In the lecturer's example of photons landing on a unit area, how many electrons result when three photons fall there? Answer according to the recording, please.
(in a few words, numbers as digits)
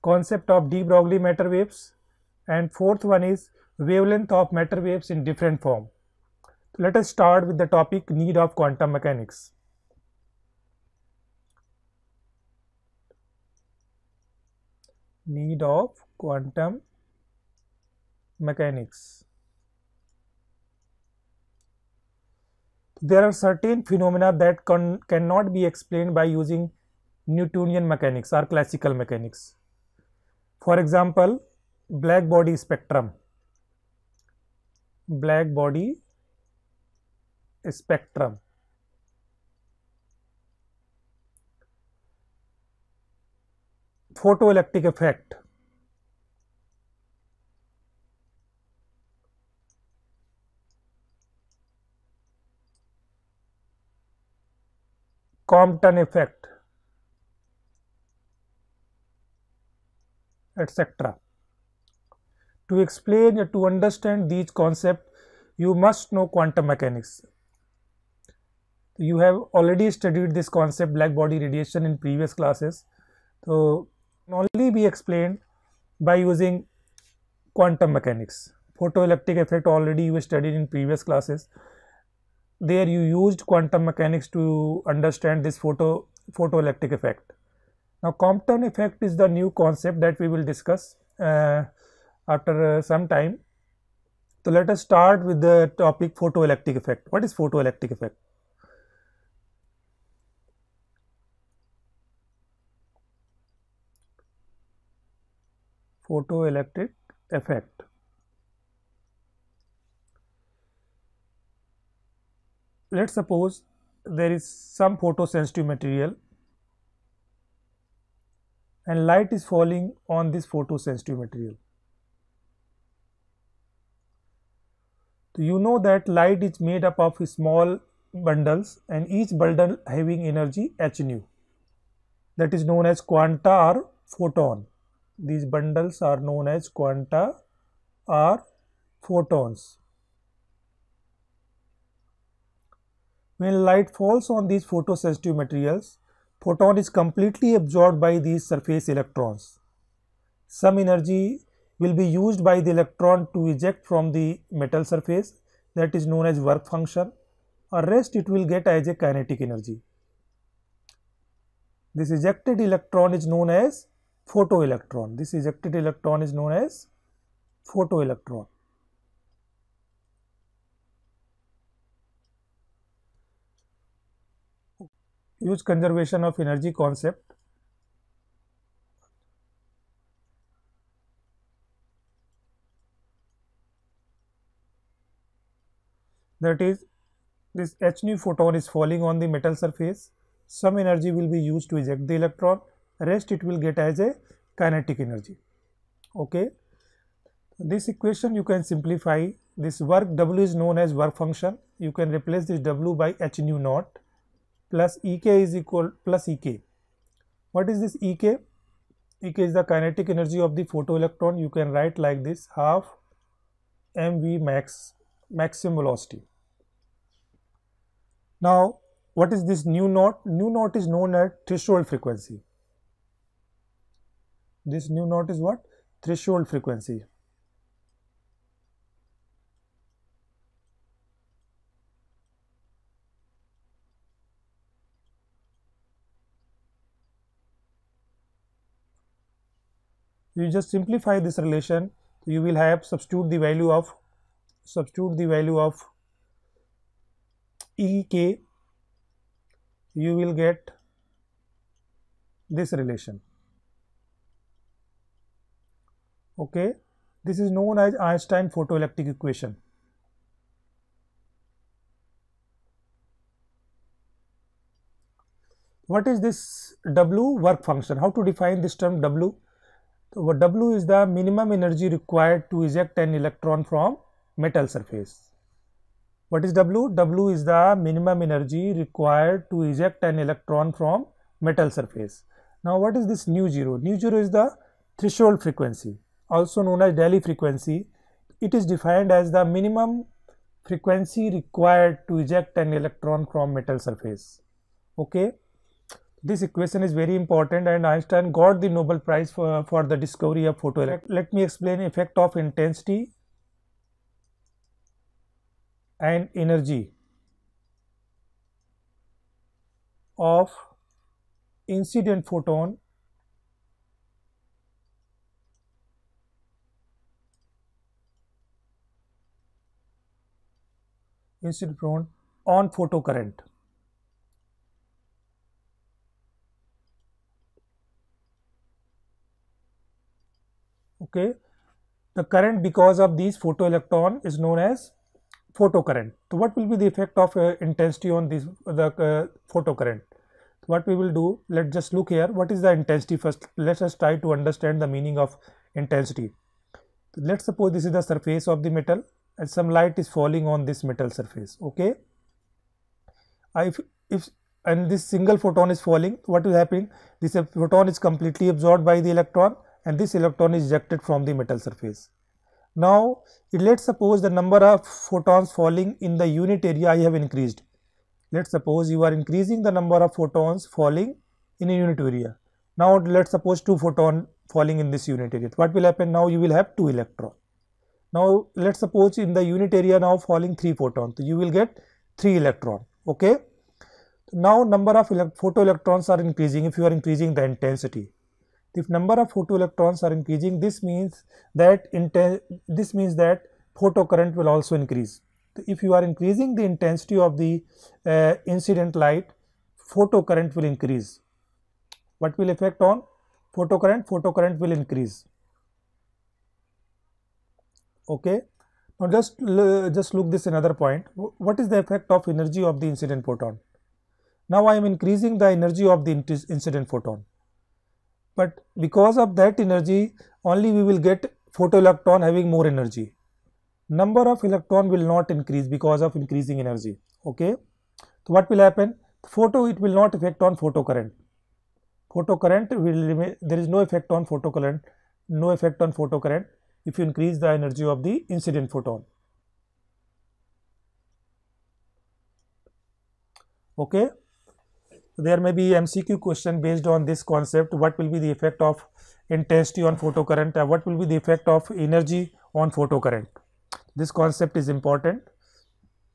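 3.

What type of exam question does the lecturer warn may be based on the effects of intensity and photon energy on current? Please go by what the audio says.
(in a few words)
MCQ.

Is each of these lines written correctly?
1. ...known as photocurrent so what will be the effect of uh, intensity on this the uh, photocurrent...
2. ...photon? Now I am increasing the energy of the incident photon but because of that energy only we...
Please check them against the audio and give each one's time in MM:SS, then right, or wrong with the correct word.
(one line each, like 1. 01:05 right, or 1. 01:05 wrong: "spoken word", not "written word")
1. 05:34 right
2. 06:53 right.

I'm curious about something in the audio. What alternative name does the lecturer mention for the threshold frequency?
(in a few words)
Delhi frequency.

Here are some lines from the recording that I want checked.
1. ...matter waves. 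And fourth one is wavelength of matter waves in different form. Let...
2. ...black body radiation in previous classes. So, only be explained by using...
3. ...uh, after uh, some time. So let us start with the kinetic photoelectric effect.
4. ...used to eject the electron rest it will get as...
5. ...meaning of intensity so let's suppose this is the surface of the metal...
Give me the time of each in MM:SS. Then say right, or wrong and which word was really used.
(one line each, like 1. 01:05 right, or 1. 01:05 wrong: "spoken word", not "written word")
1. 00:01 right
2. 01:10 right
3. 01:31 wrong: "topic", not "kinetic"
4. 03:11 right
5. 05:44 right.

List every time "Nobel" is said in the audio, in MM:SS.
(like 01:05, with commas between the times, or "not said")
04:58.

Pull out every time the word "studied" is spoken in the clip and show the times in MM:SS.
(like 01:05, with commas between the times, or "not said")
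01:09, 01:20.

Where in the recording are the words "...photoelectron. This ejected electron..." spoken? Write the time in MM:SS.
02:44.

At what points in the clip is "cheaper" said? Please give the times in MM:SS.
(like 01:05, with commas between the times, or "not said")
not said.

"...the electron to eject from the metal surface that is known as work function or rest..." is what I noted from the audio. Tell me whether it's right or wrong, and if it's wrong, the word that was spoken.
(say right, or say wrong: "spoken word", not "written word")
right.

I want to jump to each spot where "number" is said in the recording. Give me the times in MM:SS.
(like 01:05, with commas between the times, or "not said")
06:04, 06:09, 06:24, 06:28, 07:03.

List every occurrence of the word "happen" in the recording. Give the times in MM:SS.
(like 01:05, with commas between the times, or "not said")
05:56, 06:15, 07:08.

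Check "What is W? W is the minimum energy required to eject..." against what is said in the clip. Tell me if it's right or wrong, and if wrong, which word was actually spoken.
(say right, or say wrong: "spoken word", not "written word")
right.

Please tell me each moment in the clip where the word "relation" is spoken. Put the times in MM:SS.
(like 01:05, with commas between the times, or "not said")
04:01, 04:12.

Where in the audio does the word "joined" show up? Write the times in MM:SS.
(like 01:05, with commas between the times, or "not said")
not said.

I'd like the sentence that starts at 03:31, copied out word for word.
You can write like this half mv max maximum velocity.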